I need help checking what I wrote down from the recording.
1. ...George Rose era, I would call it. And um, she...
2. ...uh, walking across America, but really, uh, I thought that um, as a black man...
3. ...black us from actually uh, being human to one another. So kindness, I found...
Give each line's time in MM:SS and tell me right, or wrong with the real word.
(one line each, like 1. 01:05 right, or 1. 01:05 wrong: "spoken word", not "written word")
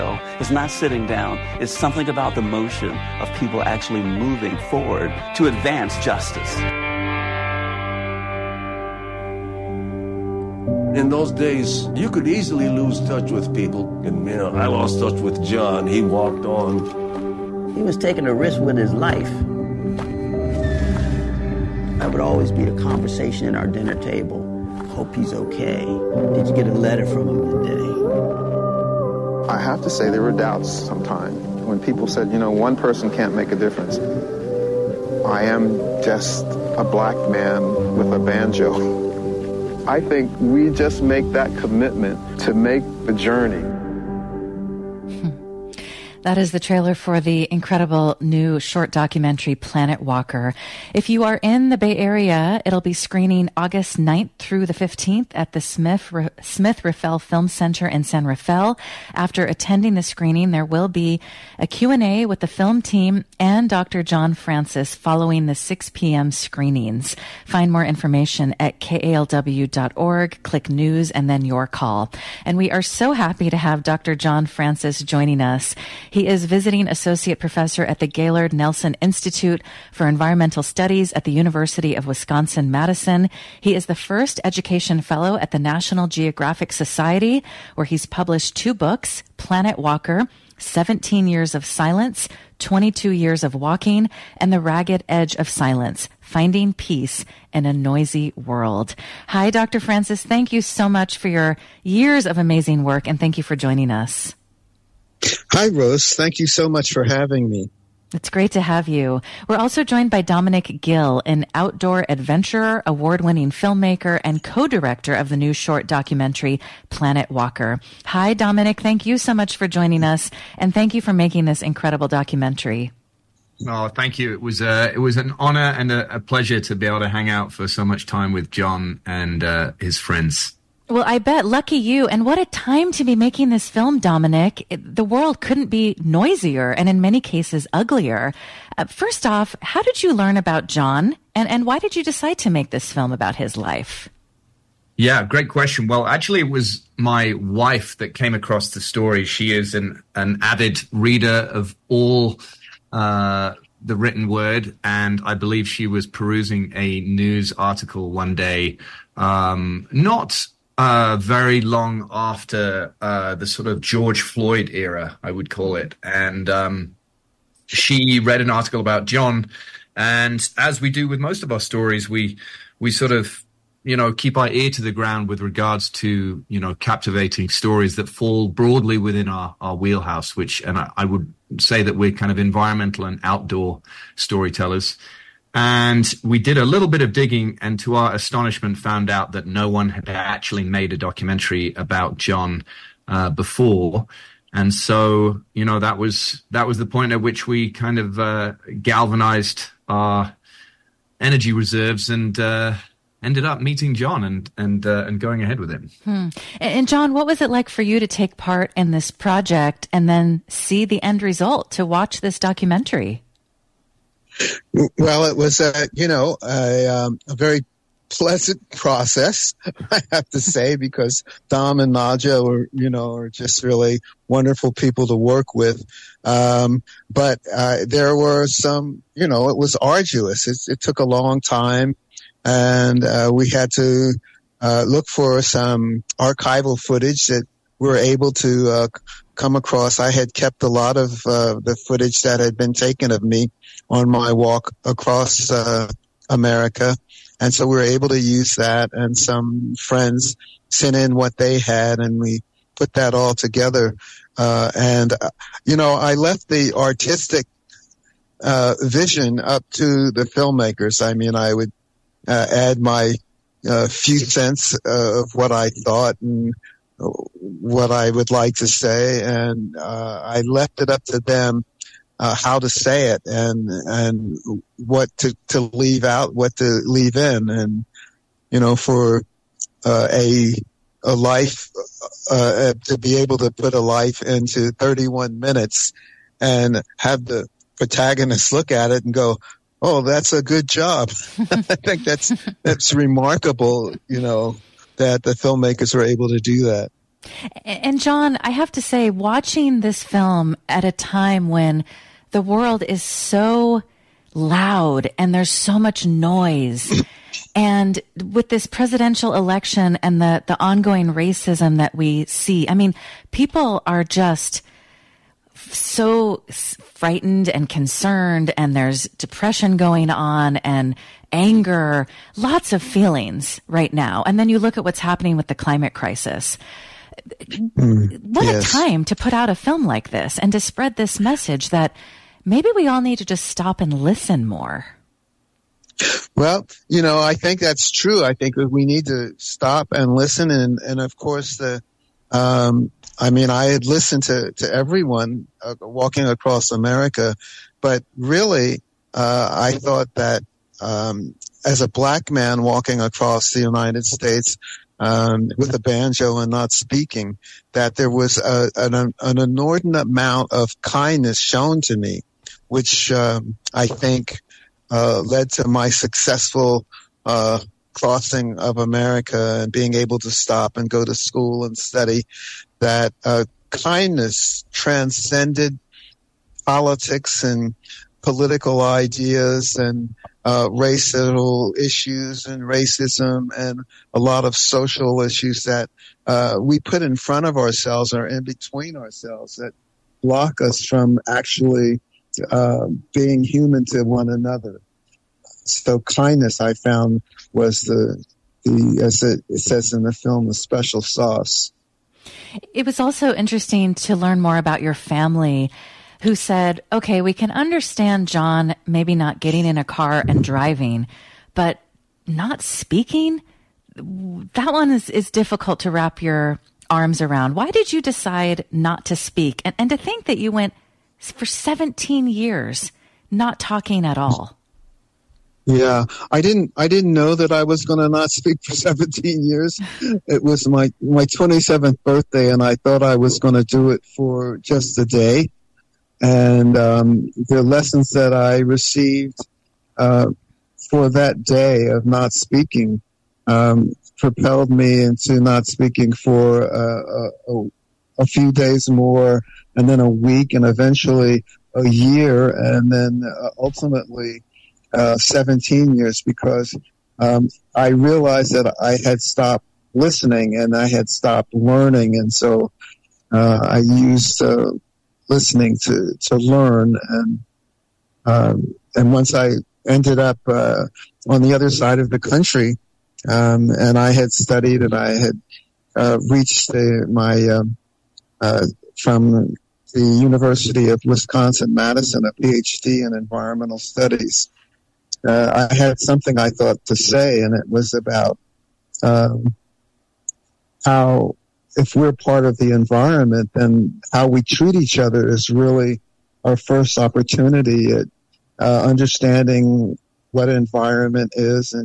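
1. 02:43 wrong: "Floyd", not "Rose"
2. 05:45 right
3. 06:30 wrong: "block", not "black".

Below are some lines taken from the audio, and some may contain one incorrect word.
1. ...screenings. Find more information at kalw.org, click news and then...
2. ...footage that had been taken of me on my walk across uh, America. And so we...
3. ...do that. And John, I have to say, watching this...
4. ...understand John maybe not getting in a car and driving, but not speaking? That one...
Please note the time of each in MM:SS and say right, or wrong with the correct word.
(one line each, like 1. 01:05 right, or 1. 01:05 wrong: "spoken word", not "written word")
1. 01:06 right
2. 04:01 right
3. 04:56 right
4. 06:47 right.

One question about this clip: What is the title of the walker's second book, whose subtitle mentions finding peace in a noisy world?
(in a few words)
The Ragged Edge of Silence.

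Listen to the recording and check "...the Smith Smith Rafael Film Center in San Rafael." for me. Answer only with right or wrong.
right.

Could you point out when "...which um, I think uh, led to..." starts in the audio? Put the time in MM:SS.
06:02.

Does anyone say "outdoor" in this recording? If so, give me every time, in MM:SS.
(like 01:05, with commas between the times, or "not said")
01:51, 03:03.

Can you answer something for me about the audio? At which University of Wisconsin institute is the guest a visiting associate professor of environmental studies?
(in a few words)
Gaylord Nelson Institute.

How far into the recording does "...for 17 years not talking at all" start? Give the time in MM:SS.
07:01.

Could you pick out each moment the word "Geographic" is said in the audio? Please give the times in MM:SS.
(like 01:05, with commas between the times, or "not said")
01:26.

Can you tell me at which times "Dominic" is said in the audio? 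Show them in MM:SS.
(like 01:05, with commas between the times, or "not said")
01:50, 01:58, 02:13.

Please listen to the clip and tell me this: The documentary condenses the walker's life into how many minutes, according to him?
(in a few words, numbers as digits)
31.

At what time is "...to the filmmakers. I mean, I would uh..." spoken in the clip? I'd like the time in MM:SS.
04:19.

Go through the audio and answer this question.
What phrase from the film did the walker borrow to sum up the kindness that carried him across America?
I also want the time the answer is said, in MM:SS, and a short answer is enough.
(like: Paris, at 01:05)
the special sauce, at 06:40.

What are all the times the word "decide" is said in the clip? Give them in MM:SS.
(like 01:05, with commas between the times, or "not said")
02:22, 06:58.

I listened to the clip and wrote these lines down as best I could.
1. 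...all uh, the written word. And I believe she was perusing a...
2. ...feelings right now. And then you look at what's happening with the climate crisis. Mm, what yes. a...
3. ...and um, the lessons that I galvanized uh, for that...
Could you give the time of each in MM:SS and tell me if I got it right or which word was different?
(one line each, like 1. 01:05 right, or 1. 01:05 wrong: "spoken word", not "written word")
1. 02:31 right
2. 05:22 right
3. 07:16 wrong: "received", not "galvanized".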